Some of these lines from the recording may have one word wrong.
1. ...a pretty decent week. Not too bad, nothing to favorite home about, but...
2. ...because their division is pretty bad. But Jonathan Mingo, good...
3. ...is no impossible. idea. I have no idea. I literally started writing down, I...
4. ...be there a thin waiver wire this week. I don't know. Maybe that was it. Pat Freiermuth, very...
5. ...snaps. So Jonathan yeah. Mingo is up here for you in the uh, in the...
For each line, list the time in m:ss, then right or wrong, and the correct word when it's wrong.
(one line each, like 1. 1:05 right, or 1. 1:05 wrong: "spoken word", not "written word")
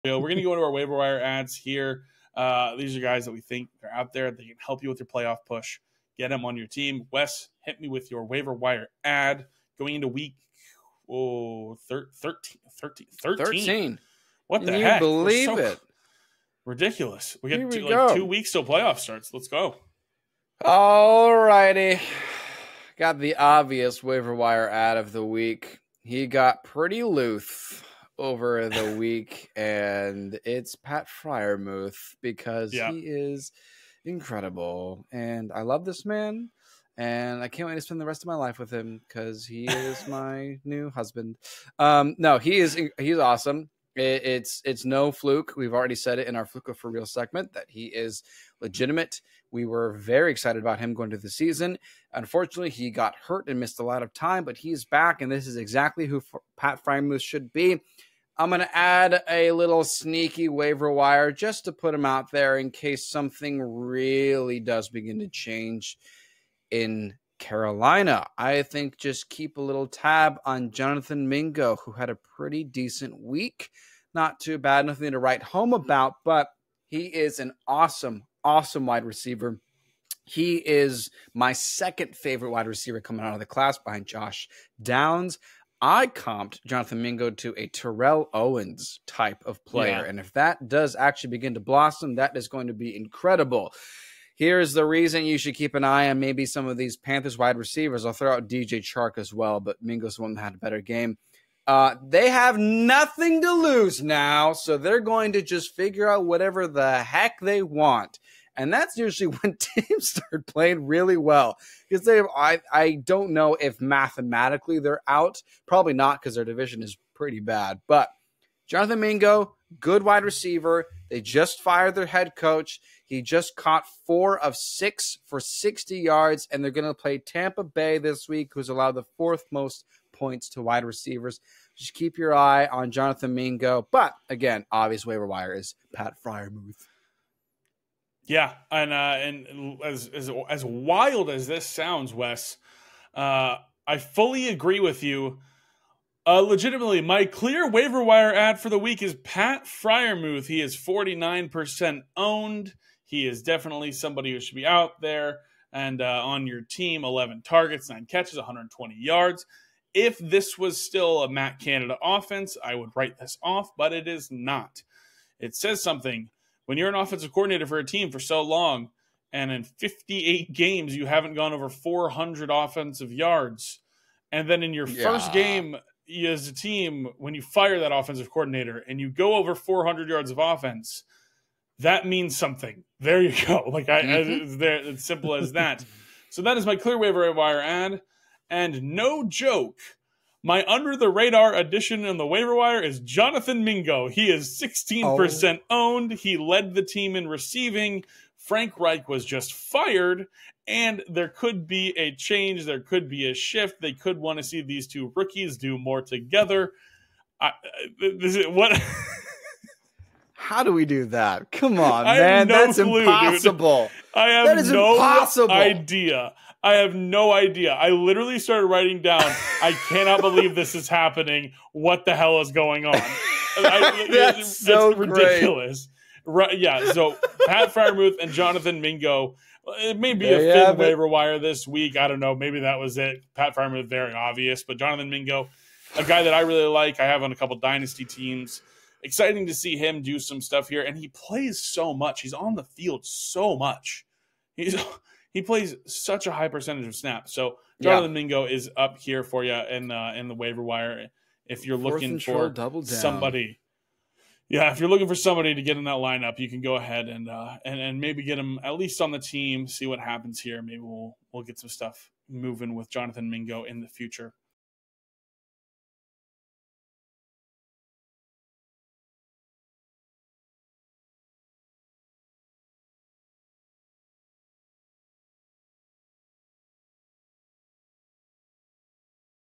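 1. 1:12 wrong: "write", not "favorite"
2. 1:56 right
3. 3:34 right
4. 3:50 right
5. 4:06 right.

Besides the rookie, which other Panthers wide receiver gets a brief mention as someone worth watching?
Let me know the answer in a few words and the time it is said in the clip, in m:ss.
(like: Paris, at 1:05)
DJ Chark, at 1:38.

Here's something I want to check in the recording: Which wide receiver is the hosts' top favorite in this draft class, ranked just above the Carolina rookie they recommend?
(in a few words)
Josh Downs.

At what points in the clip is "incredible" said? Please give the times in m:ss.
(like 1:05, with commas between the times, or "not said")
0:34, 1:32.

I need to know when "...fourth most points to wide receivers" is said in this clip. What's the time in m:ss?
2:09.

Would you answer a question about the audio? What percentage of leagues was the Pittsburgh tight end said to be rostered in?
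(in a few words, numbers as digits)
49%.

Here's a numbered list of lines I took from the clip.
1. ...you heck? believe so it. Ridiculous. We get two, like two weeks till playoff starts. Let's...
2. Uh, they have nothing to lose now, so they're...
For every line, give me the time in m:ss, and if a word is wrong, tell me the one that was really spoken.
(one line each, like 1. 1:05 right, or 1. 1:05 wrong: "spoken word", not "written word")
1. 0:14 right
2. 1:41 right.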